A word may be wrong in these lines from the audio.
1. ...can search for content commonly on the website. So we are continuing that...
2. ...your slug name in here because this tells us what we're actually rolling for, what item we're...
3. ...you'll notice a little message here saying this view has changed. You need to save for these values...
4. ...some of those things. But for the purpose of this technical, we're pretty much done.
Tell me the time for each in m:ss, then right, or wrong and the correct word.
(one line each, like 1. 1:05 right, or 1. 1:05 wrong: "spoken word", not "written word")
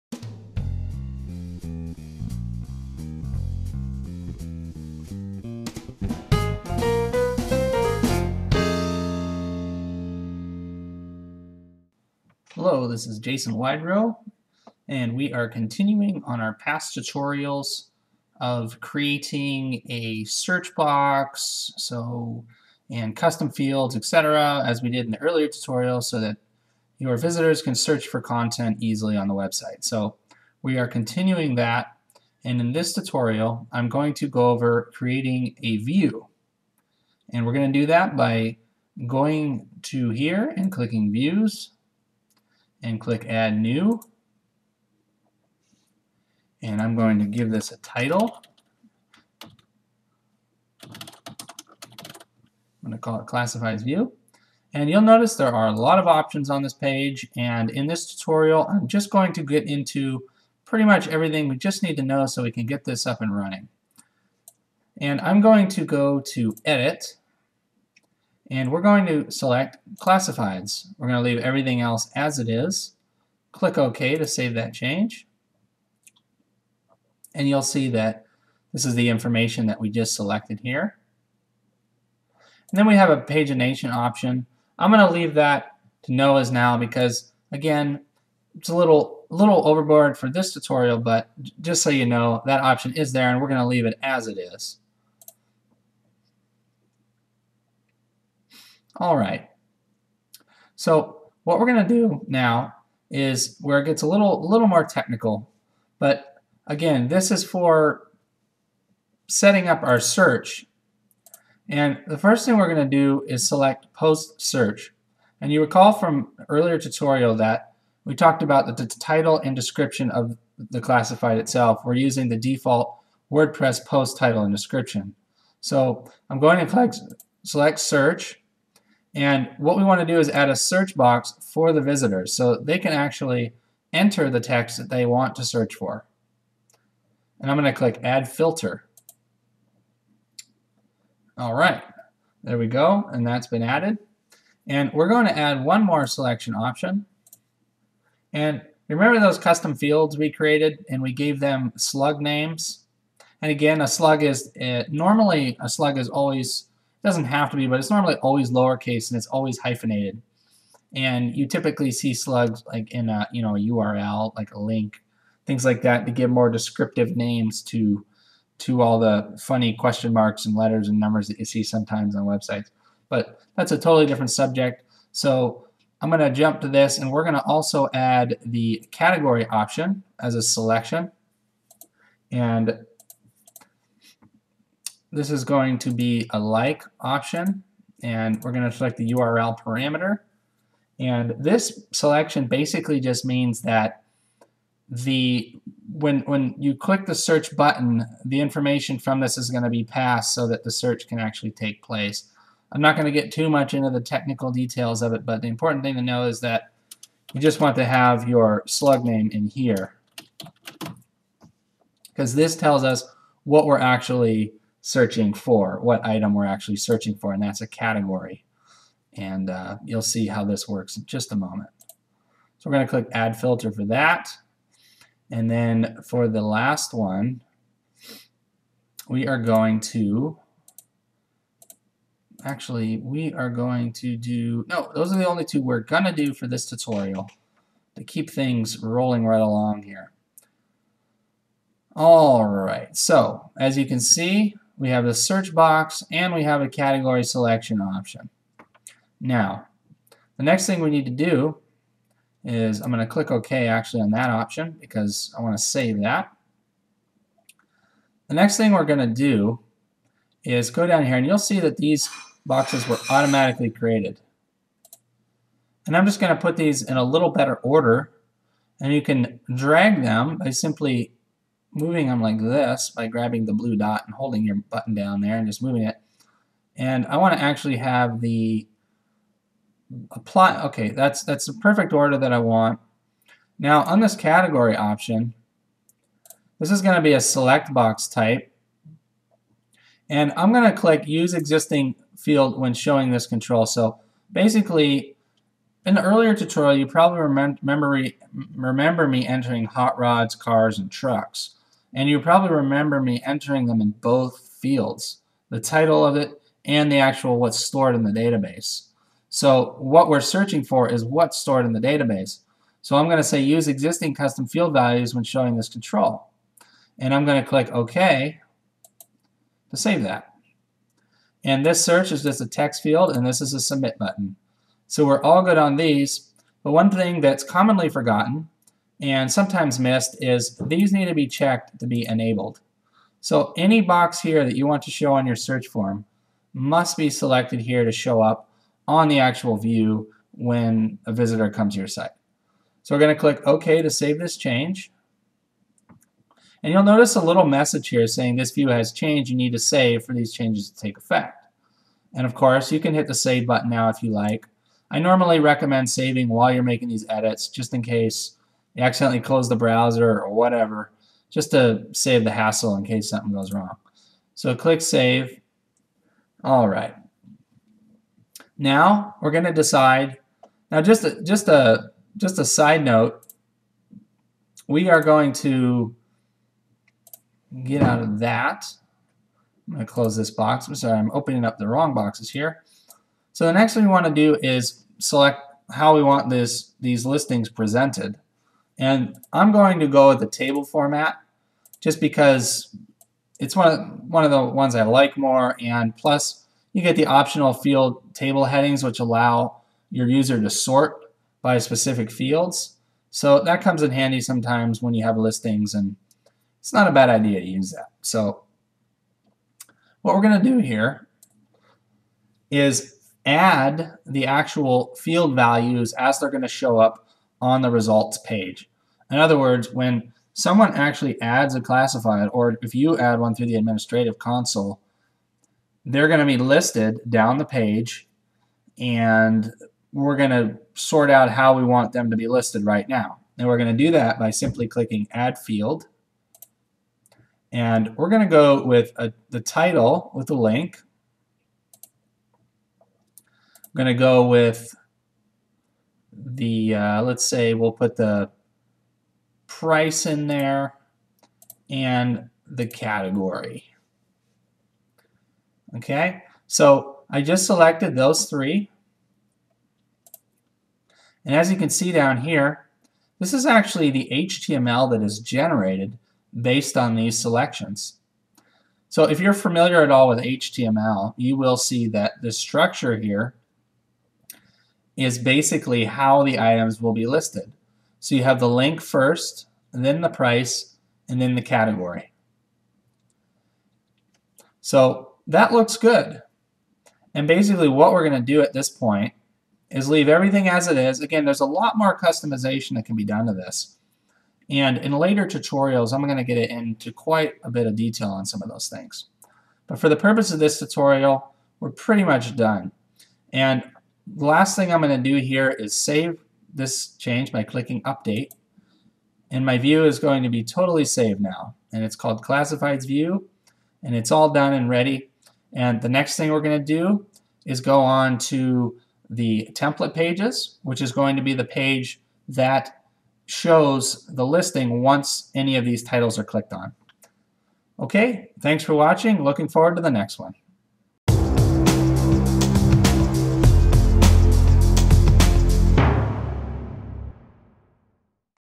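1. 0:27 wrong: "easily", not "commonly"
2. 3:28 wrong: "searching", not "rolling"
3. 5:46 wrong: "changes", not "values"
4. 8:18 wrong: "tutorial", not "technical".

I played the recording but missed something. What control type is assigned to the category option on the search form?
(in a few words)
select box.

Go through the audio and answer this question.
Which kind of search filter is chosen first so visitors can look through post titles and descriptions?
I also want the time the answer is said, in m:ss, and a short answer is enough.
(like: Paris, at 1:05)
post search, at 1:53.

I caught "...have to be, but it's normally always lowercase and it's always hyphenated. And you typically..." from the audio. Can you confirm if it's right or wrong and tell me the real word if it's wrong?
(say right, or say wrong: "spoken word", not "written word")
right.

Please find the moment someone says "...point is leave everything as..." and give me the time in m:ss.
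8:08.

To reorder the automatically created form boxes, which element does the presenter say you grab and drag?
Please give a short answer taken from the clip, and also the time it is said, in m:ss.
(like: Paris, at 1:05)
the blue dot, at 4:33.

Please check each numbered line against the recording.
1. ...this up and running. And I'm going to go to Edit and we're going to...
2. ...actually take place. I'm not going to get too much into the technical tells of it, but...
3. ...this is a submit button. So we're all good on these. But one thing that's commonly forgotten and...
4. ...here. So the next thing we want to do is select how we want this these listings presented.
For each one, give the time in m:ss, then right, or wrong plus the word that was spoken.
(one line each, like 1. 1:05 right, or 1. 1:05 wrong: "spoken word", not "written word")
1. 1:02 right
2. 3:21 wrong: "details", not "tells"
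3. 5:23 right
4. 6:22 right.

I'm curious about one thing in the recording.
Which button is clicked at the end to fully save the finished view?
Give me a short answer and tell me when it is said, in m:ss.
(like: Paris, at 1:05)
Update, at 8:27.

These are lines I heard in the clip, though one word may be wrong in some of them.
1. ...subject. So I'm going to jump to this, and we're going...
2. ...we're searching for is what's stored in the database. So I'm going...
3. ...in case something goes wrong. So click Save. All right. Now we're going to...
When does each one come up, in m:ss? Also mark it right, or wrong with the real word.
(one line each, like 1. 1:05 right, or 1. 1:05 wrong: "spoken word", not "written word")
1. 2:54 right
2. 5:10 right
3. 6:02 right.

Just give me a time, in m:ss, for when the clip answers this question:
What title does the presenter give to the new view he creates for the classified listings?
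0:53.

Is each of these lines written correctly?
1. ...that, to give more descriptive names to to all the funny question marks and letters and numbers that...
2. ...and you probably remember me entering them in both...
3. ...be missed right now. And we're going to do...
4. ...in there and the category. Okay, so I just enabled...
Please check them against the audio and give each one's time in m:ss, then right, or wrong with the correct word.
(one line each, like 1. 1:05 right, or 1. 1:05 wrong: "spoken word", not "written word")
1. 2:45 right
2. 5:01 right
3. 7:12 wrong: "listed", not "missed"
4. 7:30 wrong: "selected", not "enabled".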